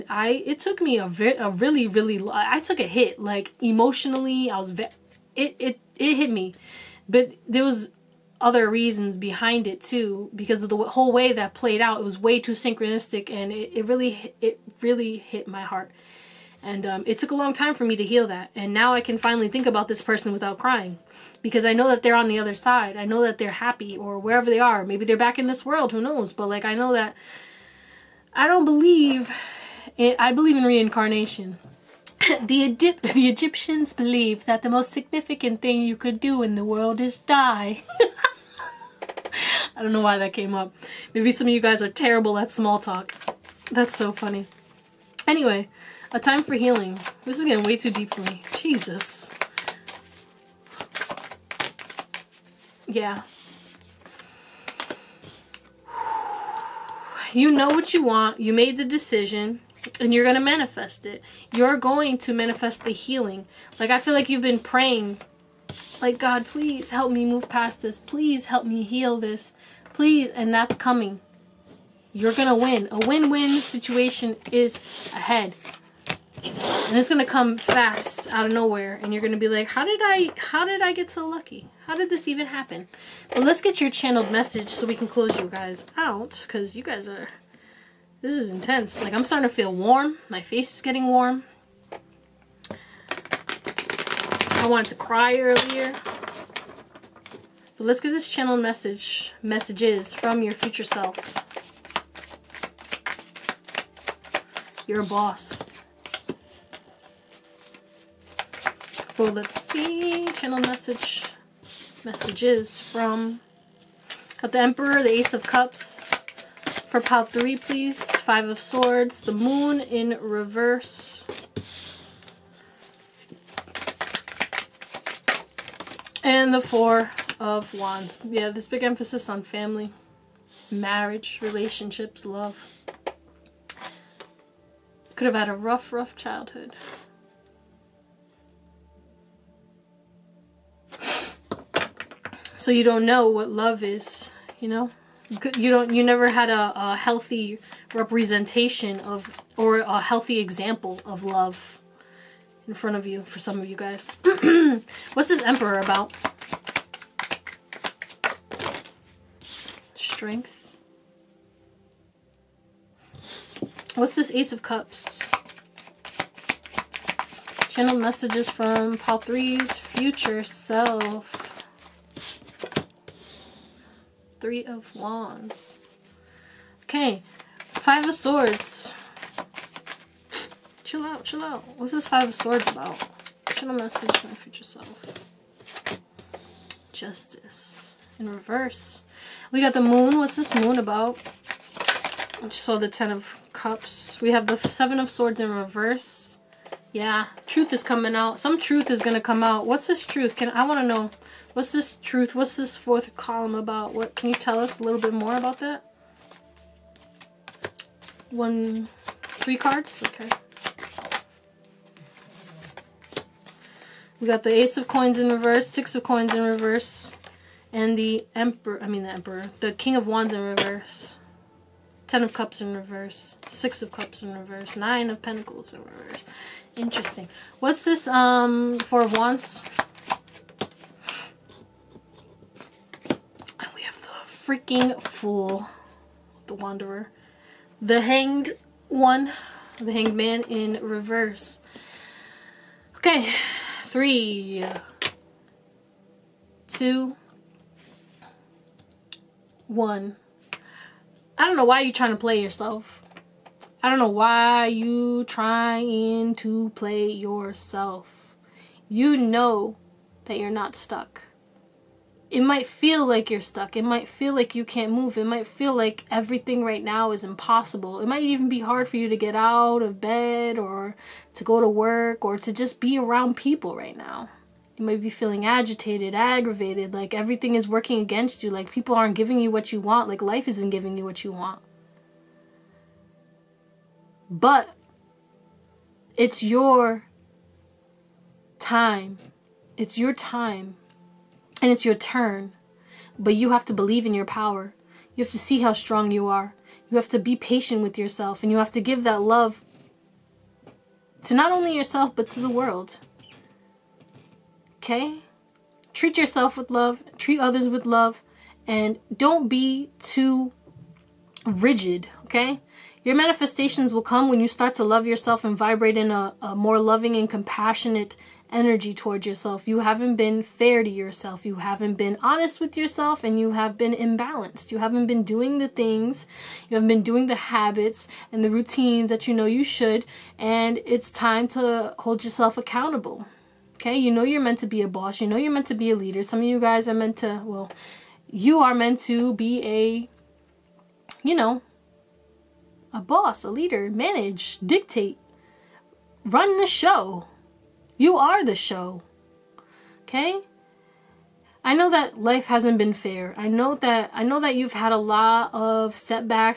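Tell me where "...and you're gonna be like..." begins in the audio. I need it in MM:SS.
01:19.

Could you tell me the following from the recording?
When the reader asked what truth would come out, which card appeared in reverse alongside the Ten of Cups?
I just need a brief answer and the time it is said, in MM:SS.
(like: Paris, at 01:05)
Seven of Swords, at 03:14.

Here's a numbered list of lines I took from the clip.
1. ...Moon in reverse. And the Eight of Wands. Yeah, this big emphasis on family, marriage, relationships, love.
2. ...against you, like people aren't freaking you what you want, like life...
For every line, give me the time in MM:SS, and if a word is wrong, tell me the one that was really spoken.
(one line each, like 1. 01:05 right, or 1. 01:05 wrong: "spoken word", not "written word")
1. 01:59 wrong: "Four", not "Eight"
2. 04:37 wrong: "giving", not "freaking".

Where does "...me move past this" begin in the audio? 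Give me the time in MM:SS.
01:07.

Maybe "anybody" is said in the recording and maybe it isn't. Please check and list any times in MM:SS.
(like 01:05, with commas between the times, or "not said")
not said.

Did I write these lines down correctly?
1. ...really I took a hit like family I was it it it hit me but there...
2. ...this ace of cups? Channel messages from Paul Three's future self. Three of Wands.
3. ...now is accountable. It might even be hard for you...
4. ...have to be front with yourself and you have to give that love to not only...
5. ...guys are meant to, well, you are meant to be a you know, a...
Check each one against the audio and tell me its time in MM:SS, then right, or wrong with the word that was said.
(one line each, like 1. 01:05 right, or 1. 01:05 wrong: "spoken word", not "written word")
1. 00:01 wrong: "emotionally", not "family"
2. 02:44 right
3. 04:26 wrong: "impossible", not "accountable"
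4. 04:56 wrong: "patient", not "front"
5. 05:36 right.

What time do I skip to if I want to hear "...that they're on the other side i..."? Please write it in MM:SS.
00:21.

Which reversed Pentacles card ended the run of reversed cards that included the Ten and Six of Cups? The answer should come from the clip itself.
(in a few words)
Nine of Pentacles.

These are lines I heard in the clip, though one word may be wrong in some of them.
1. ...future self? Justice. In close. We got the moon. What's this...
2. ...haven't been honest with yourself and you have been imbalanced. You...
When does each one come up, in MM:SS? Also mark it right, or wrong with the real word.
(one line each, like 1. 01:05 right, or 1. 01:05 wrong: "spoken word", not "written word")
1. 03:04 wrong: "reverse", not "close"
2. 05:21 right.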